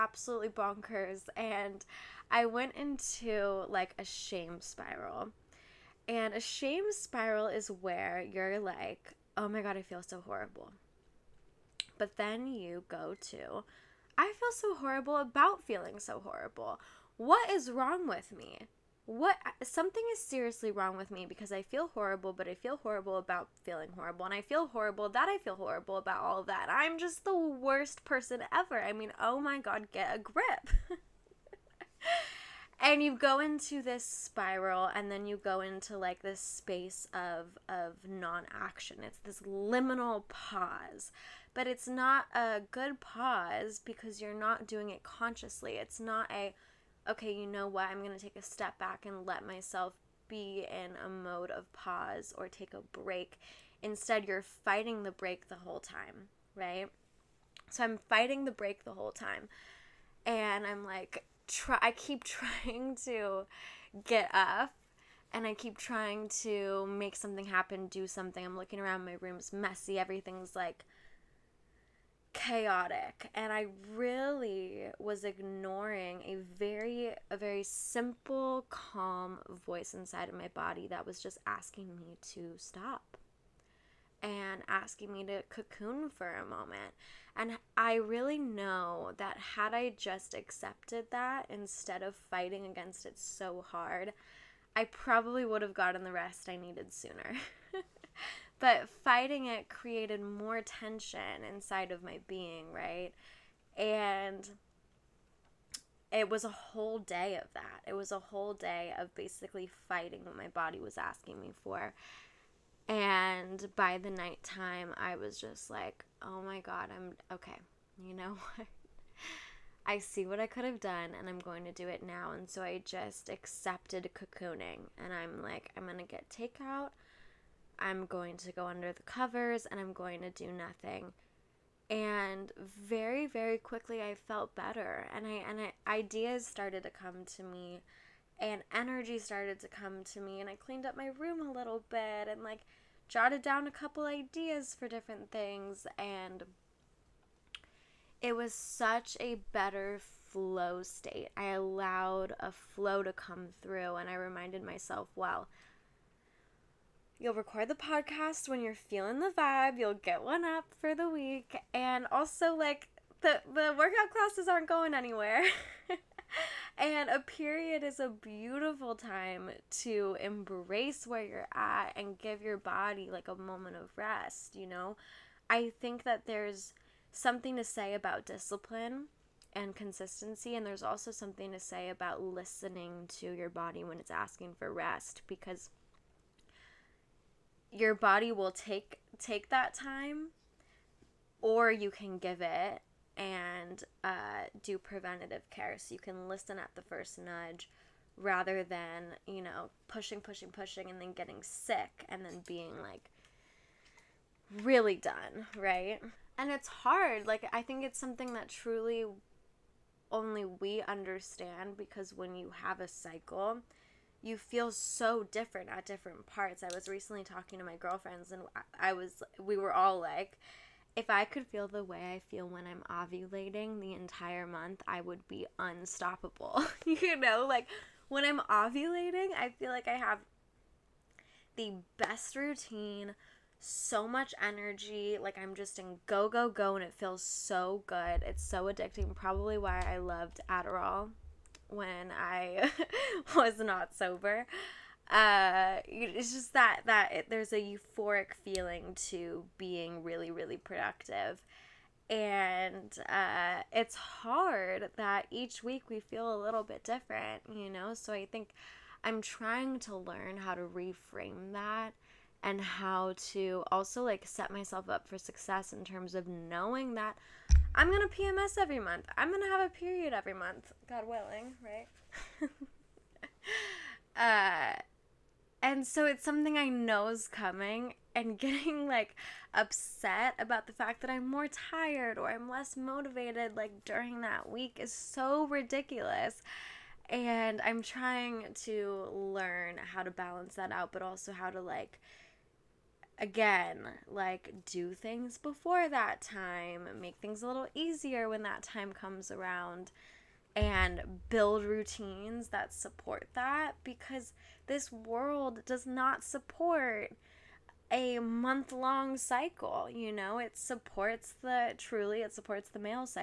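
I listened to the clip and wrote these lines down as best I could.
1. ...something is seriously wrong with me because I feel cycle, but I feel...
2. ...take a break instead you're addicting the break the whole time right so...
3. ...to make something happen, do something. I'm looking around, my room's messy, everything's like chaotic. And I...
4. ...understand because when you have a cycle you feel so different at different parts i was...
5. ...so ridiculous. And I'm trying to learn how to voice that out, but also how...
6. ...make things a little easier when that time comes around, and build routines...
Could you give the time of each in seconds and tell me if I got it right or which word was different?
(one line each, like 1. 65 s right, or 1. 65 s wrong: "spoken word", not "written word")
1. 19 s wrong: "horrible", not "cycle"
2. 52 s wrong: "fighting", not "addicting"
3. 66 s right
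4. 210 s right
5. 284 s wrong: "balance", not "voice"
6. 297 s right.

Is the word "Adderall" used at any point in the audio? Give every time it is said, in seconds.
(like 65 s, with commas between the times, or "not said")
240 s.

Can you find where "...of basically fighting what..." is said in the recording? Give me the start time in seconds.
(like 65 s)
108 s.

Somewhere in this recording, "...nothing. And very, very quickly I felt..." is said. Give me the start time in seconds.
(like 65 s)
130 s.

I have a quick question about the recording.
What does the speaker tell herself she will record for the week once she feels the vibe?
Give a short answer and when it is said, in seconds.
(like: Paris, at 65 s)
podcast, at 157 s.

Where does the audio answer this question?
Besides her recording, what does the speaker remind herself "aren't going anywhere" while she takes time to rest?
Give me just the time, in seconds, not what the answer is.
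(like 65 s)
163 s.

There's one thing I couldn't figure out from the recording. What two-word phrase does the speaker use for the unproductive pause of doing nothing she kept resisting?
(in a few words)
liminal pause.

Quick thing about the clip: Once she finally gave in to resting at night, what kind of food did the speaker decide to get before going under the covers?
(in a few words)
takeout.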